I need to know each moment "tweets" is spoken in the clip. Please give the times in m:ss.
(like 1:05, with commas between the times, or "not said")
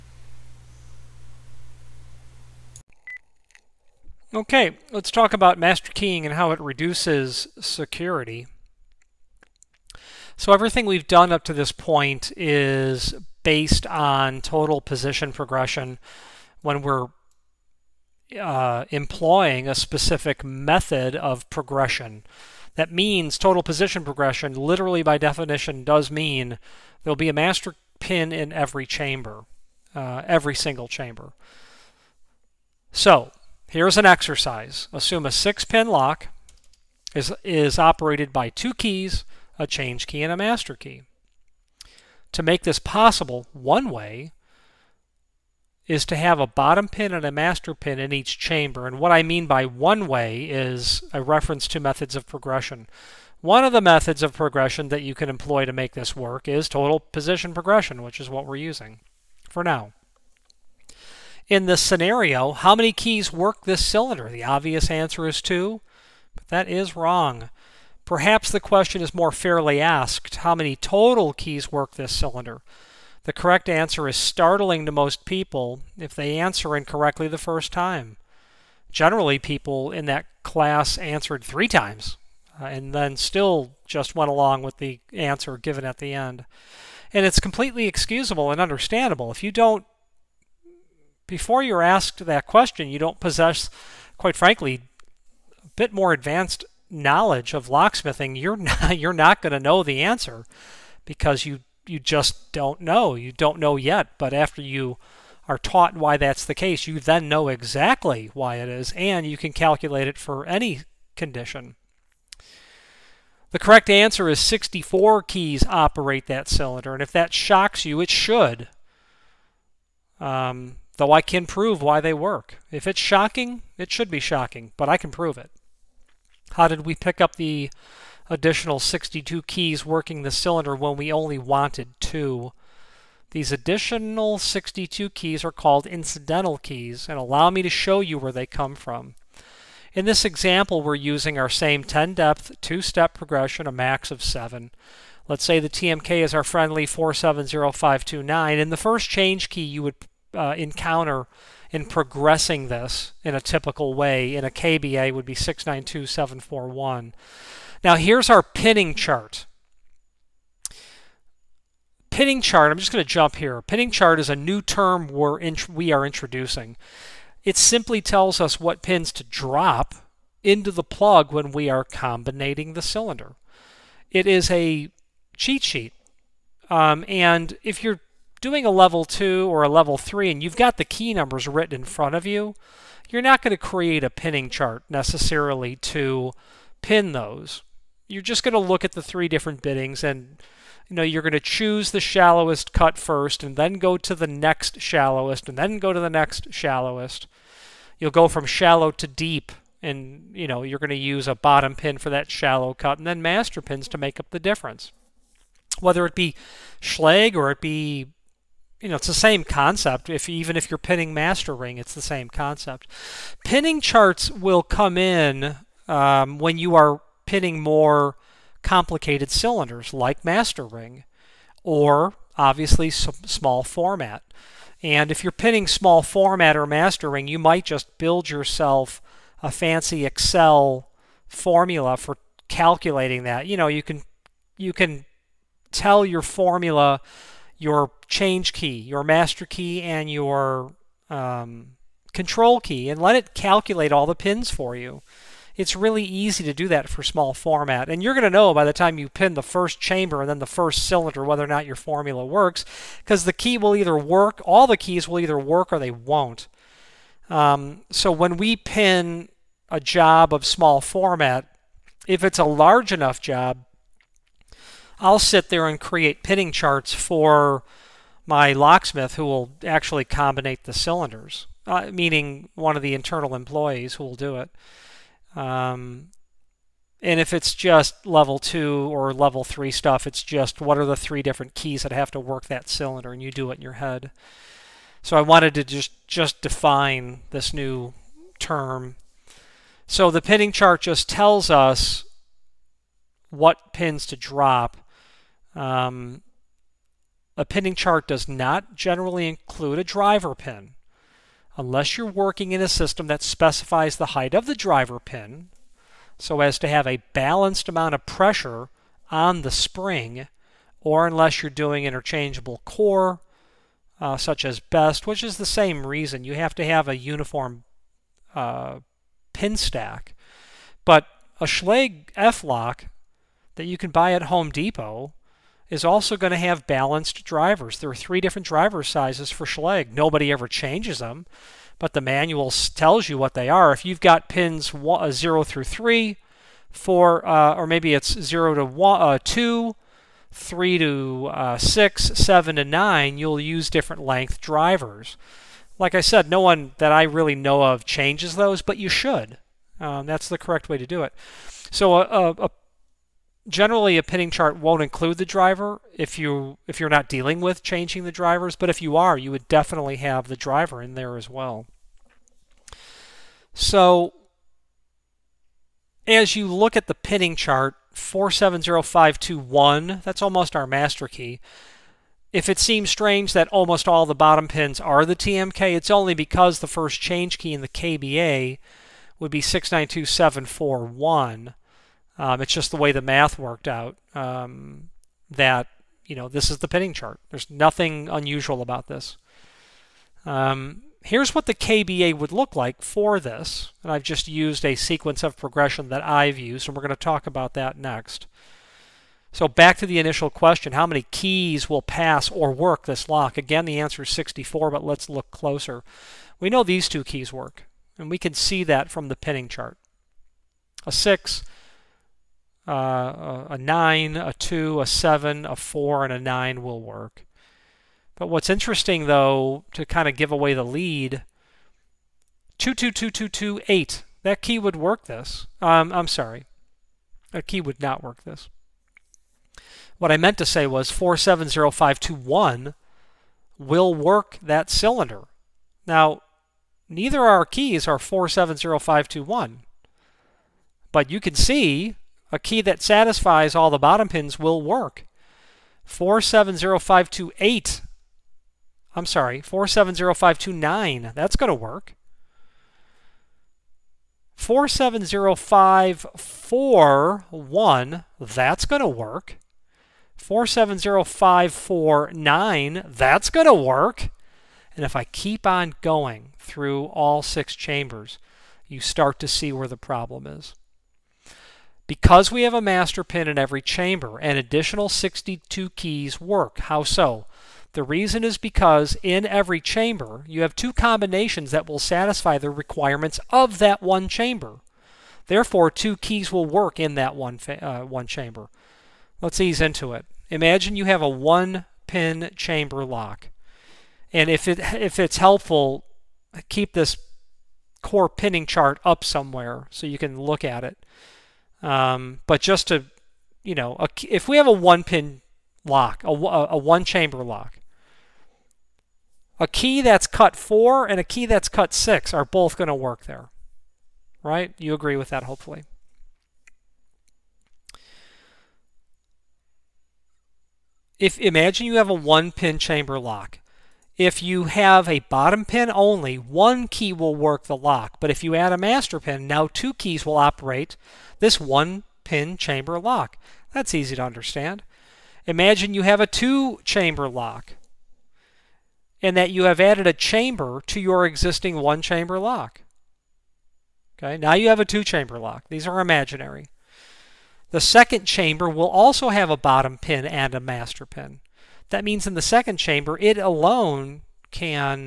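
not said.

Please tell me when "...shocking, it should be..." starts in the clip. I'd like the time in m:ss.
2:02.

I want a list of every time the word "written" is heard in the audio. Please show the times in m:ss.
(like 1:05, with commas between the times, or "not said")
3:01.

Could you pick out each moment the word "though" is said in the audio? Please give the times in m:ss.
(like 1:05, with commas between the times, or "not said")
2:00, 6:59.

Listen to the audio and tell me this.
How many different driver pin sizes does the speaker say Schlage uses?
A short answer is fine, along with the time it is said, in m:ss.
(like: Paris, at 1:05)
3, at 5:27.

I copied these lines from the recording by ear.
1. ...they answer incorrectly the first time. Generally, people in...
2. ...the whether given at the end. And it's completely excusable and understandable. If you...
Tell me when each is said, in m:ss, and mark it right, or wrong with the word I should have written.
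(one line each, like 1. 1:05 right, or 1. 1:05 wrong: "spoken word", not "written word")
1. 1:16 right
2. 1:24 wrong: "answer", not "whether".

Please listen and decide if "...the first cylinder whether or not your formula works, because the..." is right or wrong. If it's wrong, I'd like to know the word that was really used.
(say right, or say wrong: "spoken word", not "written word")
right.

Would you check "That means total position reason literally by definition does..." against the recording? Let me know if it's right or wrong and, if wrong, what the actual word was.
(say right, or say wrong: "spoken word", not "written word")
wrong: "progression", not "reason".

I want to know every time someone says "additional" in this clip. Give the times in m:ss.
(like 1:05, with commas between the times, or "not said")
2:08, 2:13, 7:54.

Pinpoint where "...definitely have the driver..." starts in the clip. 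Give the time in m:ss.
5:59.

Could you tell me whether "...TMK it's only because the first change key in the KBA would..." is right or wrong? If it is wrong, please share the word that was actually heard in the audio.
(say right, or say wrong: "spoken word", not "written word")
right.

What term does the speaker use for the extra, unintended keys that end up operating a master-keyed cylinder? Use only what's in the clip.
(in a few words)
incidental keys.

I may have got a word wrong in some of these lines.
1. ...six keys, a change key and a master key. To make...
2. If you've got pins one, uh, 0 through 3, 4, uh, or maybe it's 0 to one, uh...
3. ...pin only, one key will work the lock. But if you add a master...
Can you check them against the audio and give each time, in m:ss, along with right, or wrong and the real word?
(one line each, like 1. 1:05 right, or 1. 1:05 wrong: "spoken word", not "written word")
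1. 0:38 wrong: "two", not "six"
2. 5:33 right
3. 8:45 right.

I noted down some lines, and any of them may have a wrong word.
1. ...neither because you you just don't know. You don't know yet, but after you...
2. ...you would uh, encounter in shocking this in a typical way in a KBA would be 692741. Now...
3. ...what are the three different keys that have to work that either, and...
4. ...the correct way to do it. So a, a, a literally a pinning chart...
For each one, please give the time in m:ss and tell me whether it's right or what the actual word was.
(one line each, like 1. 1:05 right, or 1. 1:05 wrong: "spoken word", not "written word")
1. 1:40 wrong: "answer", not "neither"
2. 2:29 wrong: "progressing", not "shocking"
3. 4:40 wrong: "cylinder", not "either"
4. 5:50 wrong: "generally", not "literally".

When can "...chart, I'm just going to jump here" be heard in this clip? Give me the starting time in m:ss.
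2:42.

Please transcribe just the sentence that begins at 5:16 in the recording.
You have to have a uniform uh, pin stack.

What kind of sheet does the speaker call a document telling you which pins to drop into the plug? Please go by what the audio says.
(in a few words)
cheat sheet.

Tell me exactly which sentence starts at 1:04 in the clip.
The obvious answer is two, but that is wrong.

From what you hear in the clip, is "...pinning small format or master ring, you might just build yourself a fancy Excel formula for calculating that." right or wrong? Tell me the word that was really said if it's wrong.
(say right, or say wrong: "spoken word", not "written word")
right.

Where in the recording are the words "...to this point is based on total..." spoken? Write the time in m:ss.
0:11.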